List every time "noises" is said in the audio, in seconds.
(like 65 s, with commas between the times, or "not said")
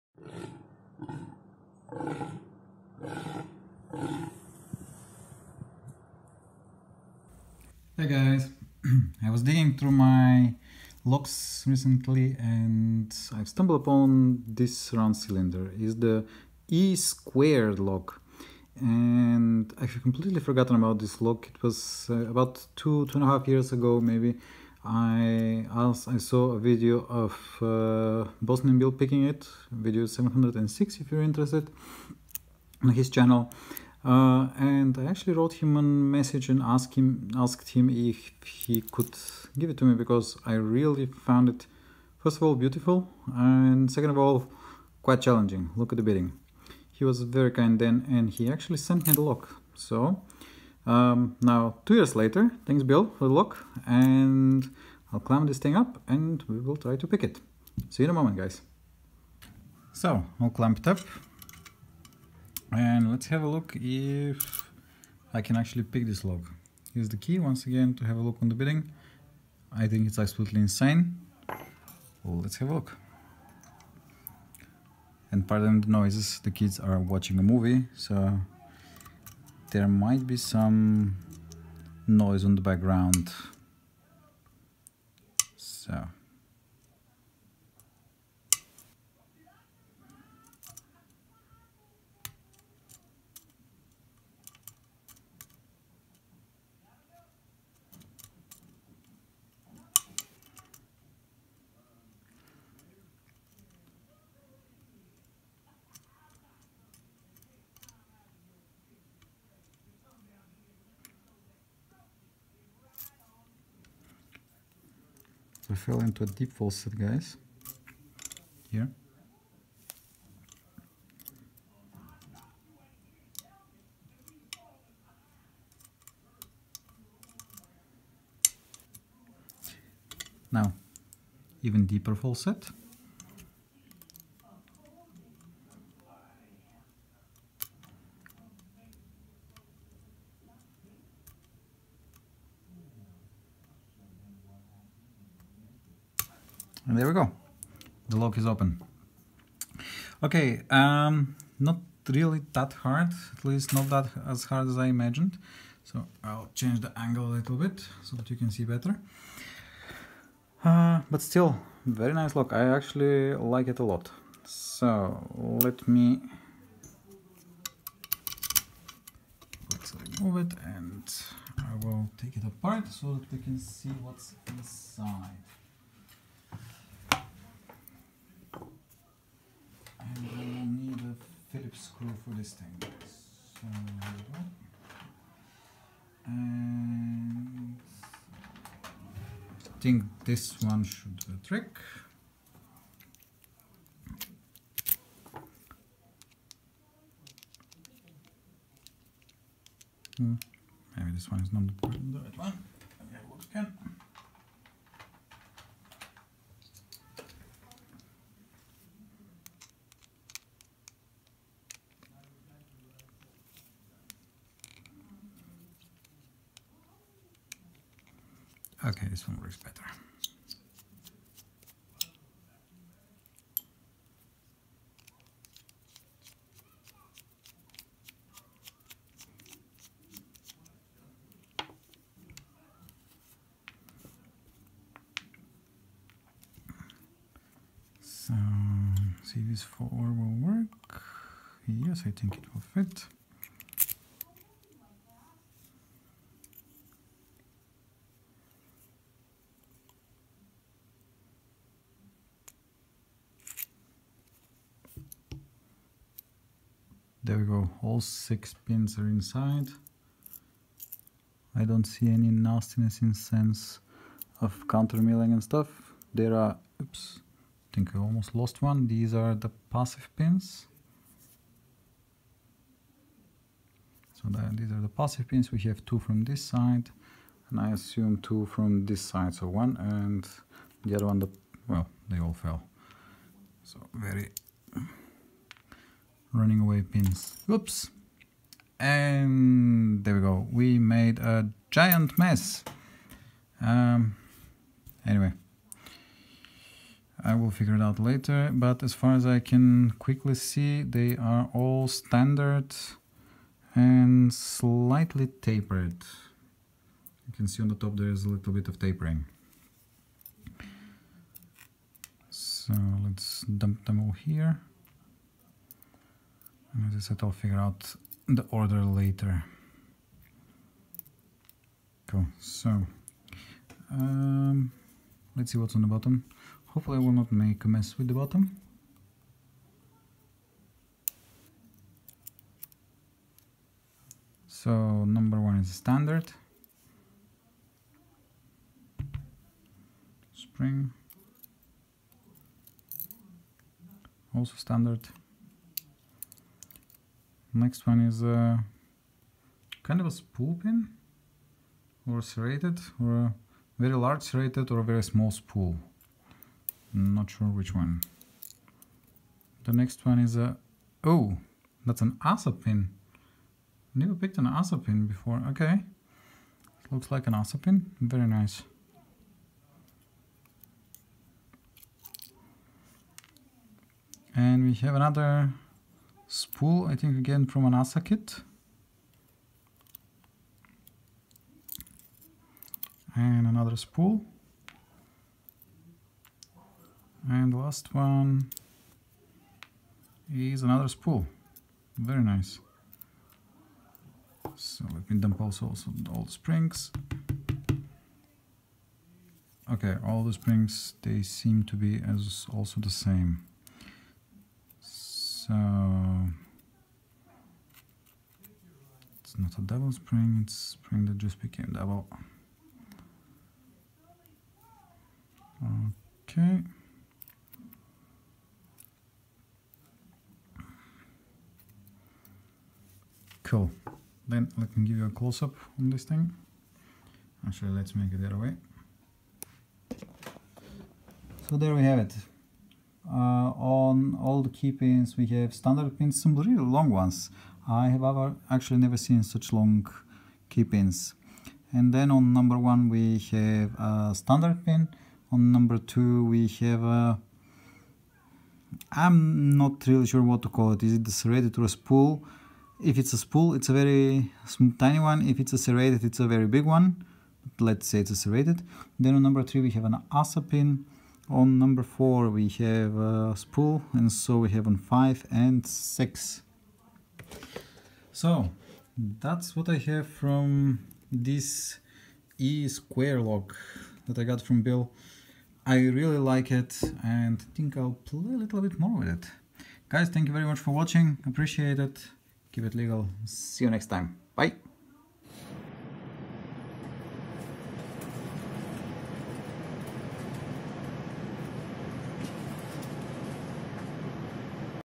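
75 s, 82 s.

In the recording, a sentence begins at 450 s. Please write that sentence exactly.
Is it a serrated or a spool?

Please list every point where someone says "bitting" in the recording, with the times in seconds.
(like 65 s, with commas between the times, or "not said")
46 s, 68 s.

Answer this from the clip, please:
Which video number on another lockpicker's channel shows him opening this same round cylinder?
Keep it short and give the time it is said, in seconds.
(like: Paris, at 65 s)
706, at 29 s.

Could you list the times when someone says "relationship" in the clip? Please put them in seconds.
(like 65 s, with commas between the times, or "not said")
not said.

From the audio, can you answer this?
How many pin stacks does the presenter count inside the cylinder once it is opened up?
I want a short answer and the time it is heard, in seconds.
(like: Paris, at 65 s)
6, at 258 s.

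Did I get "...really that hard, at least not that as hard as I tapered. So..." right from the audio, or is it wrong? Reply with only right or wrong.
wrong.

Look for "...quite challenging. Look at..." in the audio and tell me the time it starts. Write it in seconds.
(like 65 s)
45 s.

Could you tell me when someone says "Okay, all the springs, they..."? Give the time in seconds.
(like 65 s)
399 s.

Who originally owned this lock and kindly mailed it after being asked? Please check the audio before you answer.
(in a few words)
Bosnian Bill.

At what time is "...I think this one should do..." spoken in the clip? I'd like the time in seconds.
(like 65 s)
189 s.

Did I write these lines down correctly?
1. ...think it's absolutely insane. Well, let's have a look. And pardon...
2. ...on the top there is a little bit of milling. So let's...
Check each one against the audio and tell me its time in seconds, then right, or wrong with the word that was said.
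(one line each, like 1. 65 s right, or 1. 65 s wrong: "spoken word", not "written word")
1. 69 s right
2. 307 s wrong: "tapering", not "milling".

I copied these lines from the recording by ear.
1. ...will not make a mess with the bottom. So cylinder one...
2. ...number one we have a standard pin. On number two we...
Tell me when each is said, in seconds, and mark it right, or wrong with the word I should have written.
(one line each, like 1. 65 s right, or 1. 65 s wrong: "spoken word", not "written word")
1. 327 s wrong: "number", not "cylinder"
2. 442 s right.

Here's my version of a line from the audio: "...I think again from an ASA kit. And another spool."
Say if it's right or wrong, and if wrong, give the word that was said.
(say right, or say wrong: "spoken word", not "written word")
right.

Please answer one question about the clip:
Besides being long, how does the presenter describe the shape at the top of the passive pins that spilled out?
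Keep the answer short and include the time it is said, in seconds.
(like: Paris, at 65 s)
slightly tapered, at 304 s.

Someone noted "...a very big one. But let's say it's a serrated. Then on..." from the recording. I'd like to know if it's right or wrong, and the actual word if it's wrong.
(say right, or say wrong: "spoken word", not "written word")
right.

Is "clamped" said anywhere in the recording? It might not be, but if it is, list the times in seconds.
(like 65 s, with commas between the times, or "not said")
60 s.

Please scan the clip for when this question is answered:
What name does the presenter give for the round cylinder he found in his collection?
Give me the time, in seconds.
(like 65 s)
16 s.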